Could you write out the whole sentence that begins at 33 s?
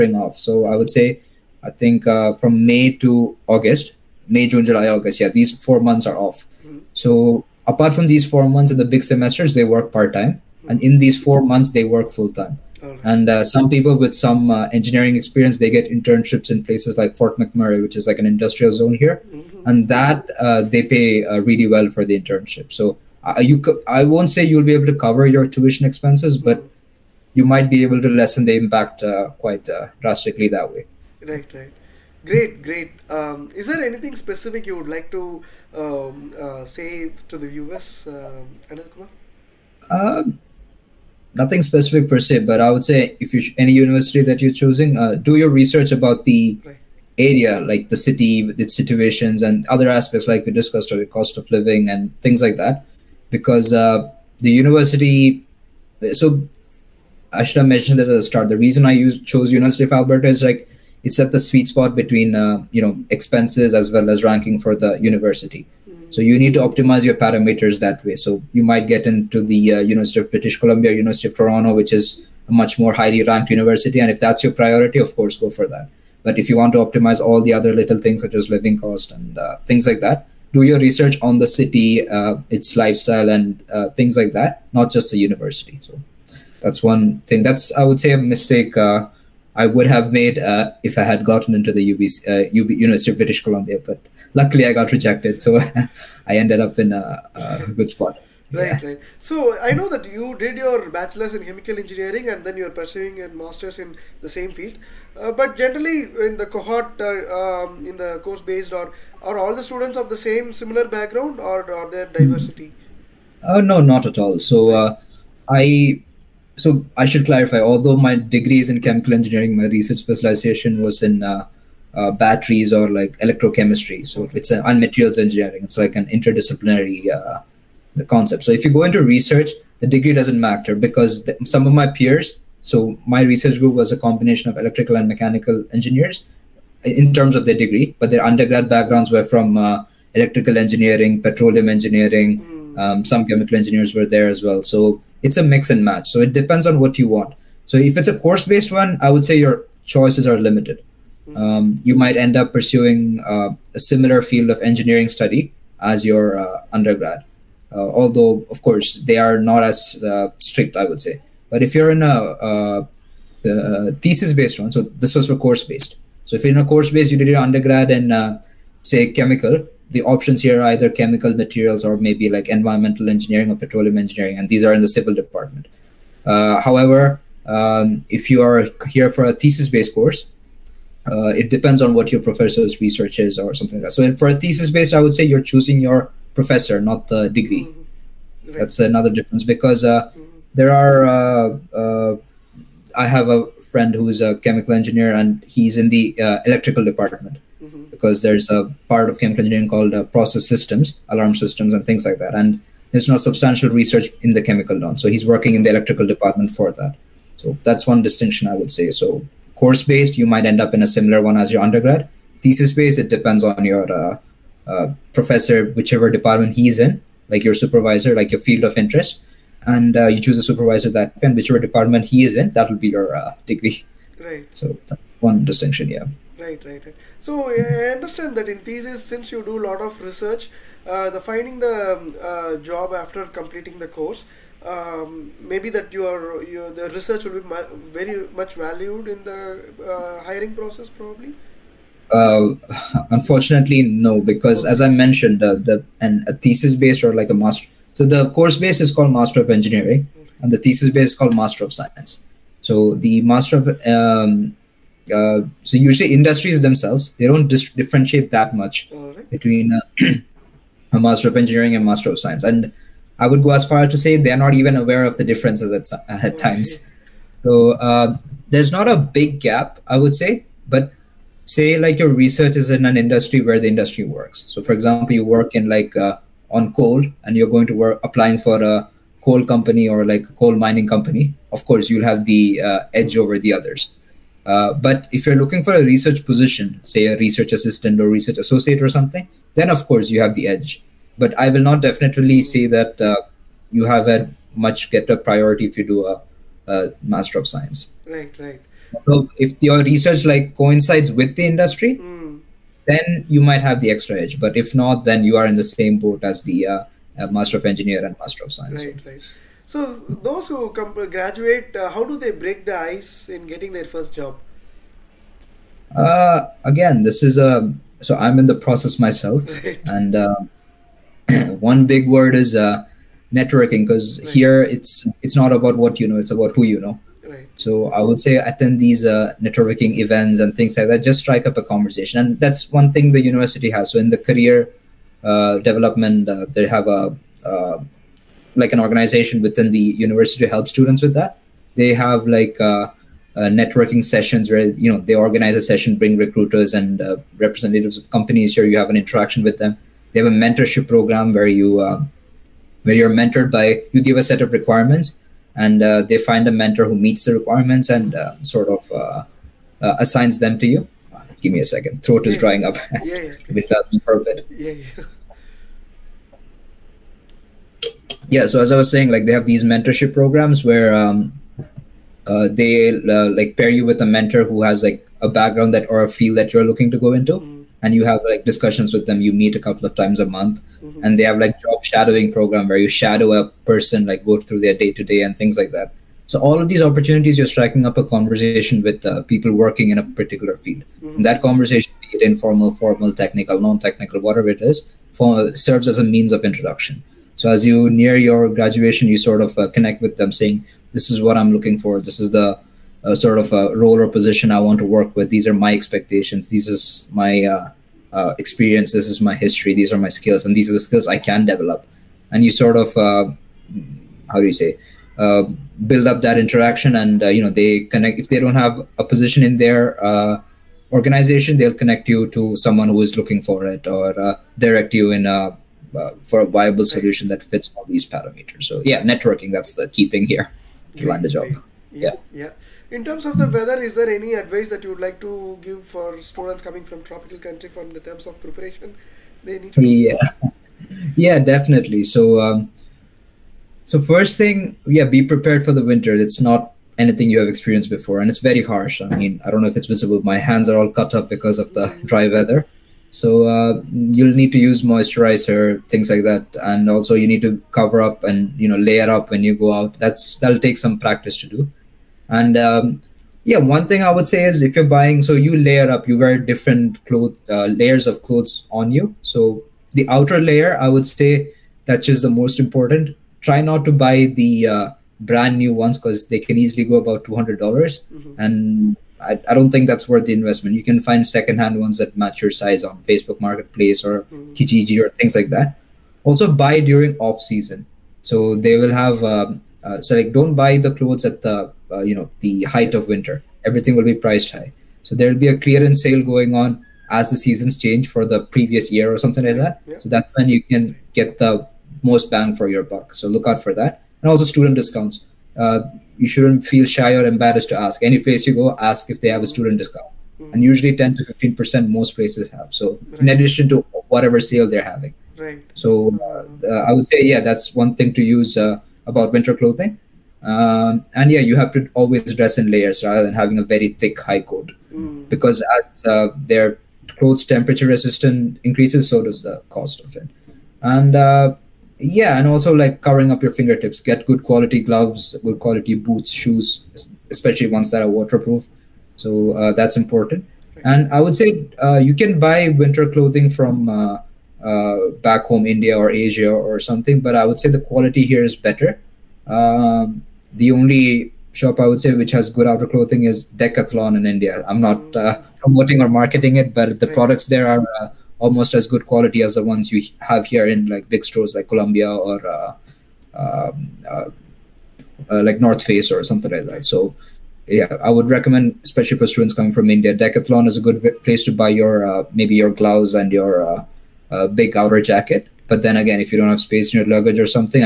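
Um, is there anything specific you would like to um, uh, say to the viewers, uh, um, Anil Kumar?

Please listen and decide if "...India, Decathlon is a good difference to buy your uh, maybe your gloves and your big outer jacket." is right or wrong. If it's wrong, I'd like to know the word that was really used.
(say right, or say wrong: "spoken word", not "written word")
wrong: "place", not "difference".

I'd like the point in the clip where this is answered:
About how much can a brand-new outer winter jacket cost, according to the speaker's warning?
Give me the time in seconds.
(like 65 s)
477 s.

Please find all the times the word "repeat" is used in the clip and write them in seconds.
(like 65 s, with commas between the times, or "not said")
not said.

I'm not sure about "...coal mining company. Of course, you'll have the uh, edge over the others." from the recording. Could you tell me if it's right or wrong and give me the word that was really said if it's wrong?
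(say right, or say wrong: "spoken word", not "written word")
right.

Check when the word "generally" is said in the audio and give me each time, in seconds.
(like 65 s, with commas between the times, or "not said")
105 s.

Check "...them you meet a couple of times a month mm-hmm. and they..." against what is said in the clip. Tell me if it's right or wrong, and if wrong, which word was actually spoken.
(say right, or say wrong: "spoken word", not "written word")
right.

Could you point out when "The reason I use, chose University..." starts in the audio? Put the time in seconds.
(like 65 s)
58 s.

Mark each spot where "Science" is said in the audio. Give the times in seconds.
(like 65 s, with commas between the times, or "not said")
251 s, 262 s, 297 s, 308 s.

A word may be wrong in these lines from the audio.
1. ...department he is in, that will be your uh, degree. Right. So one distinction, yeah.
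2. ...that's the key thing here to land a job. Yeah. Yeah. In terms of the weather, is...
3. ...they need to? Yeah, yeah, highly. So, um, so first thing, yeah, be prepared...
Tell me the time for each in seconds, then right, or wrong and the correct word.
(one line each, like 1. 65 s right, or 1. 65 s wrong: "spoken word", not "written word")
1. 221 s right
2. 429 s right
3. 439 s wrong: "definitely", not "highly".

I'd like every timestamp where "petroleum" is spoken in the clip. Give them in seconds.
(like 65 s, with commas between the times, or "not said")
141 s, 173 s.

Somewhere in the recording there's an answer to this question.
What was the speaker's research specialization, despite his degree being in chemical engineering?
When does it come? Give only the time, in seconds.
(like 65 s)
122 s.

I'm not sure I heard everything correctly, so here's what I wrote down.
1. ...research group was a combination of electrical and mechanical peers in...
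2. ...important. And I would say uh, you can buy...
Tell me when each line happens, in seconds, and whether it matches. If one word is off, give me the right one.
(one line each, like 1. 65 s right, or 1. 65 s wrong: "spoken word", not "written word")
1. 133 s wrong: "engineers", not "peers"
2. 539 s right.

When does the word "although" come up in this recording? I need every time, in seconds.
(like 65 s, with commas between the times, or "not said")
117 s, 157 s.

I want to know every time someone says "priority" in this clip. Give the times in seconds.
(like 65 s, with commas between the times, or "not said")
74 s, 295 s.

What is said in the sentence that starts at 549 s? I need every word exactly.
Um, the only shop I would say which has good outer clothing is Decathlon in India.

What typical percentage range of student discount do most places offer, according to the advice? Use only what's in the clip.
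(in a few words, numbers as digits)
10 to 15%.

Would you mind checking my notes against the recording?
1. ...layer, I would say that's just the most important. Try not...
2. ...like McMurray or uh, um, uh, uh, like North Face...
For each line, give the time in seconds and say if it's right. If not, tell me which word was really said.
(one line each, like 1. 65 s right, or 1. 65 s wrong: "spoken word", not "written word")
1. 470 s right
2. 561 s wrong: "Columbia", not "McMurray".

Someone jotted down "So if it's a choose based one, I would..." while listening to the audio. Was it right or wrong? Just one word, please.
wrong.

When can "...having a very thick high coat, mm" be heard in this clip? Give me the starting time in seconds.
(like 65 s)
523 s.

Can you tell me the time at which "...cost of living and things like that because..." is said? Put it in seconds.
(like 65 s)
51 s.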